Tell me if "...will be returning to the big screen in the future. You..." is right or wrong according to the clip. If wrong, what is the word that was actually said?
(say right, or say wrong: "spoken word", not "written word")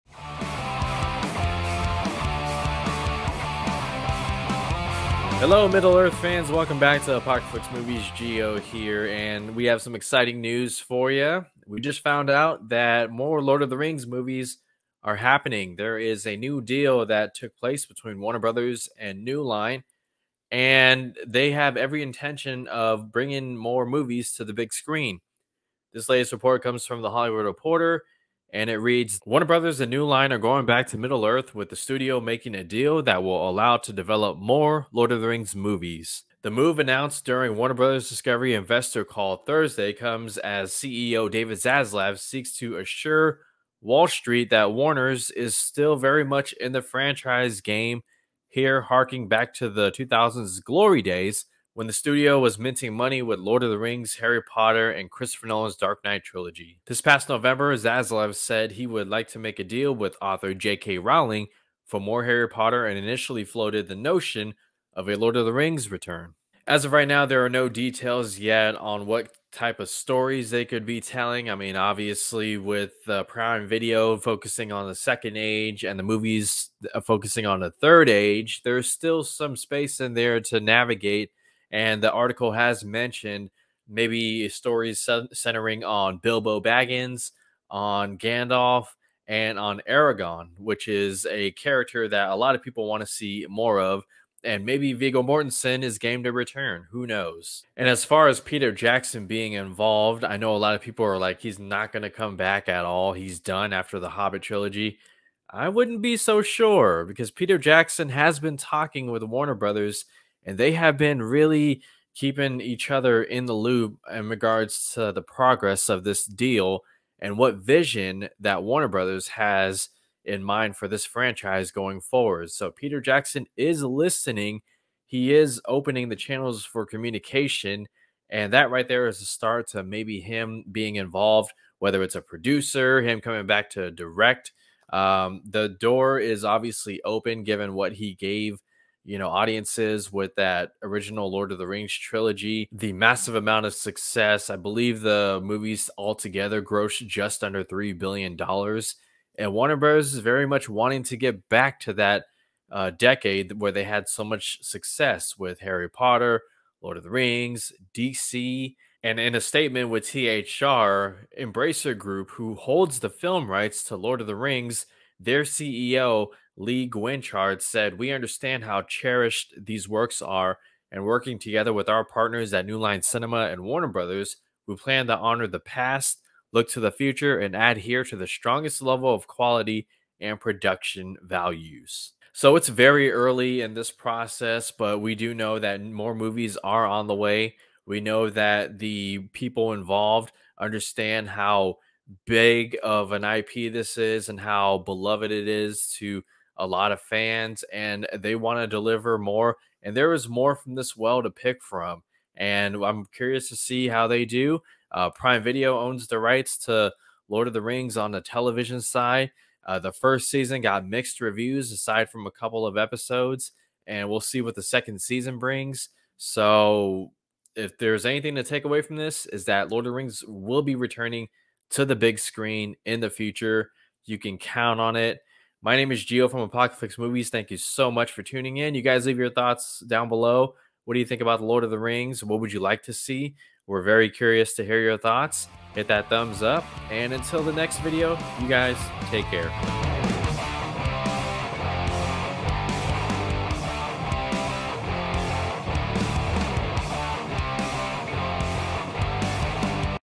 right.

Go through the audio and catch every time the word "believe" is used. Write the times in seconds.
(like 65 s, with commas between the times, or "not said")
144 s.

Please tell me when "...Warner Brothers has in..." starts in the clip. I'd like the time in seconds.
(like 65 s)
118 s.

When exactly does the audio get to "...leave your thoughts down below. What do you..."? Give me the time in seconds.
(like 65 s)
229 s.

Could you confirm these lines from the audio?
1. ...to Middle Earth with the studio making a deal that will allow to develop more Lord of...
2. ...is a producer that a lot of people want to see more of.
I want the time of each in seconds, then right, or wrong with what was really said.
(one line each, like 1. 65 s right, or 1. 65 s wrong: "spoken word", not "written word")
1. 30 s right
2. 90 s wrong: "character", not "producer".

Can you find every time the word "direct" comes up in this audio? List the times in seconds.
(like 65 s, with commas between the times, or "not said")
133 s.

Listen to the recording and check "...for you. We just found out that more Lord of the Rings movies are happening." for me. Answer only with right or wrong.
right.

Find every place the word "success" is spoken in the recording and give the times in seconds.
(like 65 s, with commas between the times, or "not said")
143 s, 154 s.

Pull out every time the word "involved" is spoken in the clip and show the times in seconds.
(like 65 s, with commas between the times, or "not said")
99 s, 130 s, 189 s.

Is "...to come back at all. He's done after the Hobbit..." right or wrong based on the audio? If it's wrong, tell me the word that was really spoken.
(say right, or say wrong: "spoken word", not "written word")
right.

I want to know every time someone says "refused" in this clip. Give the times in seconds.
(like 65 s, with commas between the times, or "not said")
not said.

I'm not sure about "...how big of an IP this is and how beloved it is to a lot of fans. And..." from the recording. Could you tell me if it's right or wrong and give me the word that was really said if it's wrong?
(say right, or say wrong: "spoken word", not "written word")
right.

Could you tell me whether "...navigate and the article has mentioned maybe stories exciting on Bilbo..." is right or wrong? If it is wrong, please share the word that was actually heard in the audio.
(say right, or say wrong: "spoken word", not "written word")
wrong: "centering", not "exciting".